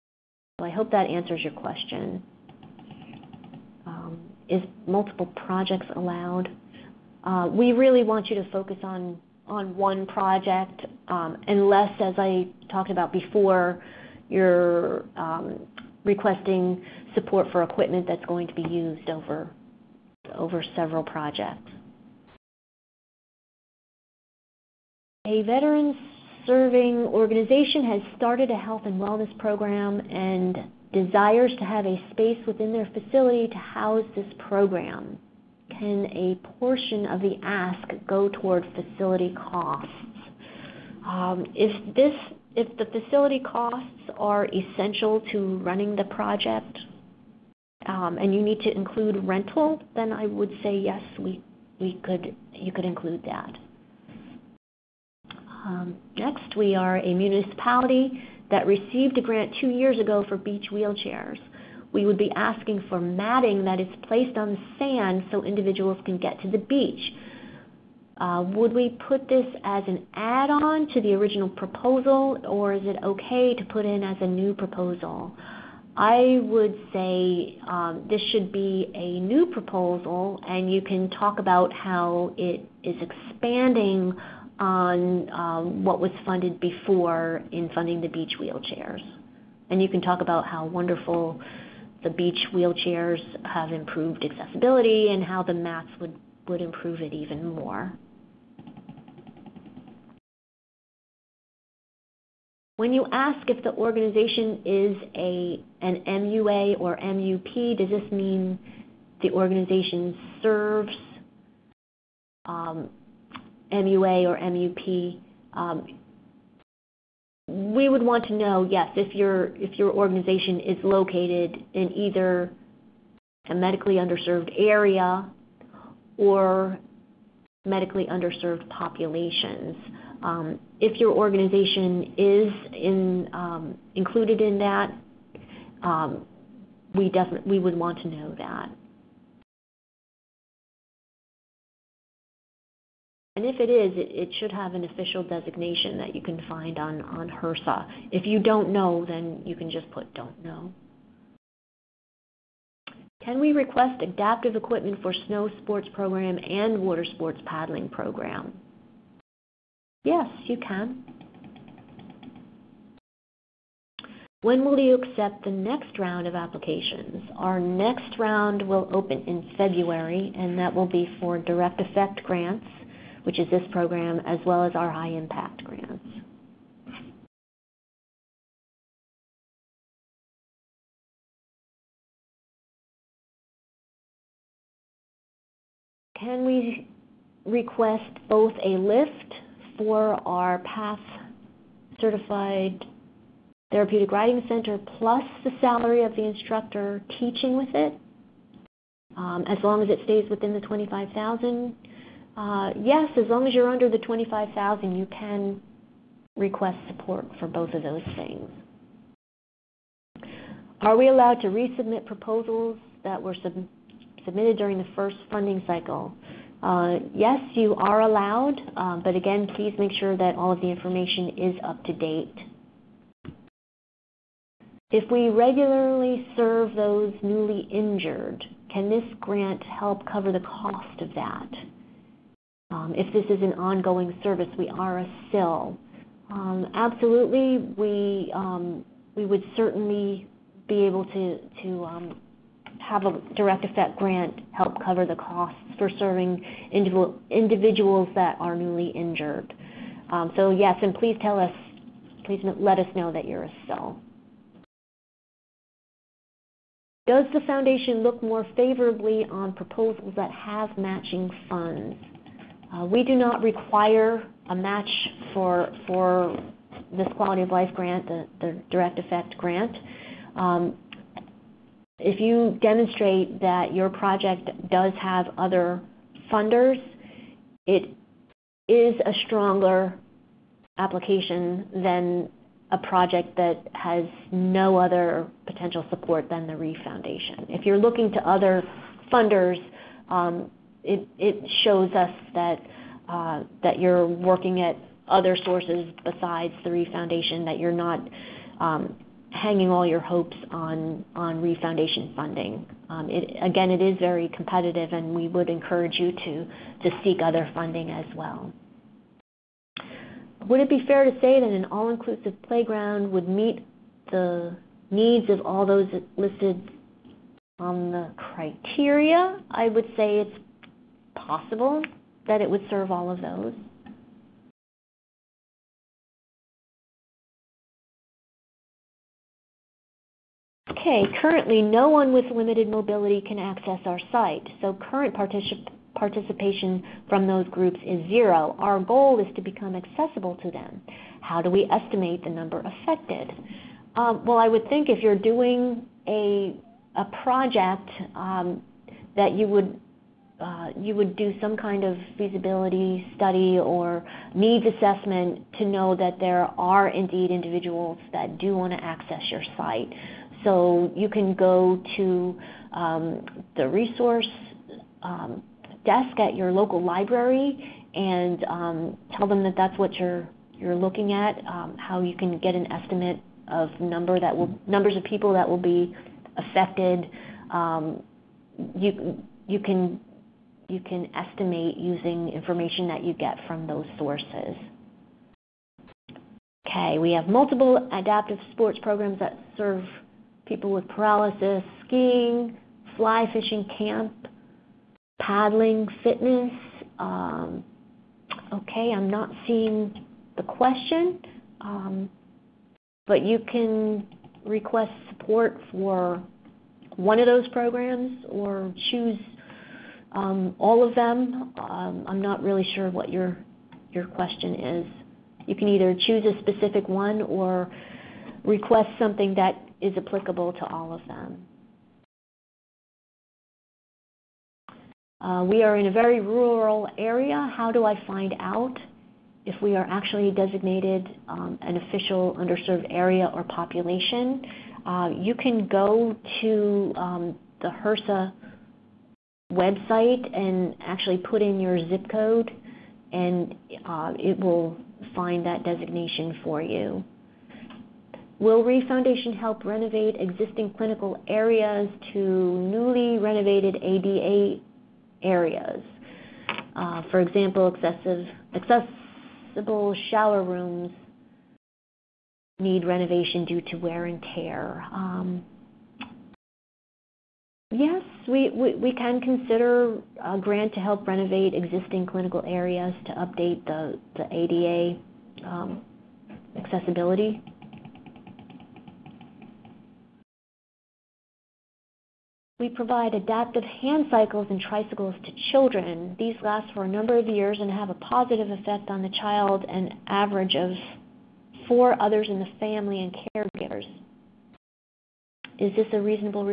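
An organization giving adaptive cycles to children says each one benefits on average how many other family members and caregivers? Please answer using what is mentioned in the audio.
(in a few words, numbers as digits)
4.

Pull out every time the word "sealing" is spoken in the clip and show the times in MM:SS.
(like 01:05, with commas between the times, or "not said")
not said.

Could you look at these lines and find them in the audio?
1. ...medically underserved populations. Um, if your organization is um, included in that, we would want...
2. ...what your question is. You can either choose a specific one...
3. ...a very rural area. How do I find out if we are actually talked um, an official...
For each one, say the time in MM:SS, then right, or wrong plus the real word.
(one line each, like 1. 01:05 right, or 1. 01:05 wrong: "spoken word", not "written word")
1. 02:07 right
2. 06:52 right
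3. 07:05 wrong: "designated", not "talked".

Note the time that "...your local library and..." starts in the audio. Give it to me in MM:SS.
06:06.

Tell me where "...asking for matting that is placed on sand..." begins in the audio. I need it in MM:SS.
01:02.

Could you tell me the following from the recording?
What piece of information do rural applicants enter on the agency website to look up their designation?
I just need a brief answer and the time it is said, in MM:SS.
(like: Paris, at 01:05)
zip code, at 07:21.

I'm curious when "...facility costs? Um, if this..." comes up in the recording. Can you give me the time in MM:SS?
00:38.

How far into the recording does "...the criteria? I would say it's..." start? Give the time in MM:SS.
05:17.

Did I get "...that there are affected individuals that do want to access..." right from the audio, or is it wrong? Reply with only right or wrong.
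wrong.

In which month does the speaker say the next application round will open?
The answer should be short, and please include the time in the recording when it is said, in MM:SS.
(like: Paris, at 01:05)
February, at 02:49.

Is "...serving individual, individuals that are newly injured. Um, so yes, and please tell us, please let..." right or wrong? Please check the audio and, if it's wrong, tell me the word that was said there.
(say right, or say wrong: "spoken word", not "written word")
right.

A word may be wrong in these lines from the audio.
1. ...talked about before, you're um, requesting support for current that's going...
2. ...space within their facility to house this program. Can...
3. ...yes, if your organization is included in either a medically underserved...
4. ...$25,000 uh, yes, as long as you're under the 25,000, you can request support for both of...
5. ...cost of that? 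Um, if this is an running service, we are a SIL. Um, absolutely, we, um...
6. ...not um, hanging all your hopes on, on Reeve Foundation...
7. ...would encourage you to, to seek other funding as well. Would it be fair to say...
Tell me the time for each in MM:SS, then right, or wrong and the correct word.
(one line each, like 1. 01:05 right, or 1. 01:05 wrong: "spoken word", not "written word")
1. 00:12 wrong: "equipment", not "current"
2. 00:32 right
3. 01:58 wrong: "located", not "included"
4. 03:20 right
5. 03:50 wrong: "ongoing", not "running"
6. 04:57 right
7. 05:05 right.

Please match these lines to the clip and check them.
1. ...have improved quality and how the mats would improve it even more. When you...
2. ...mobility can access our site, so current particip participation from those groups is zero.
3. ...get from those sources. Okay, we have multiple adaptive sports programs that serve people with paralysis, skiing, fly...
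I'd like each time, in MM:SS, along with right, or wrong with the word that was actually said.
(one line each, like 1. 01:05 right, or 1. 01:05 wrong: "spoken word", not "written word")
1. 01:33 wrong: "accessibility", not "quality"
2. 05:32 right
3. 06:23 right.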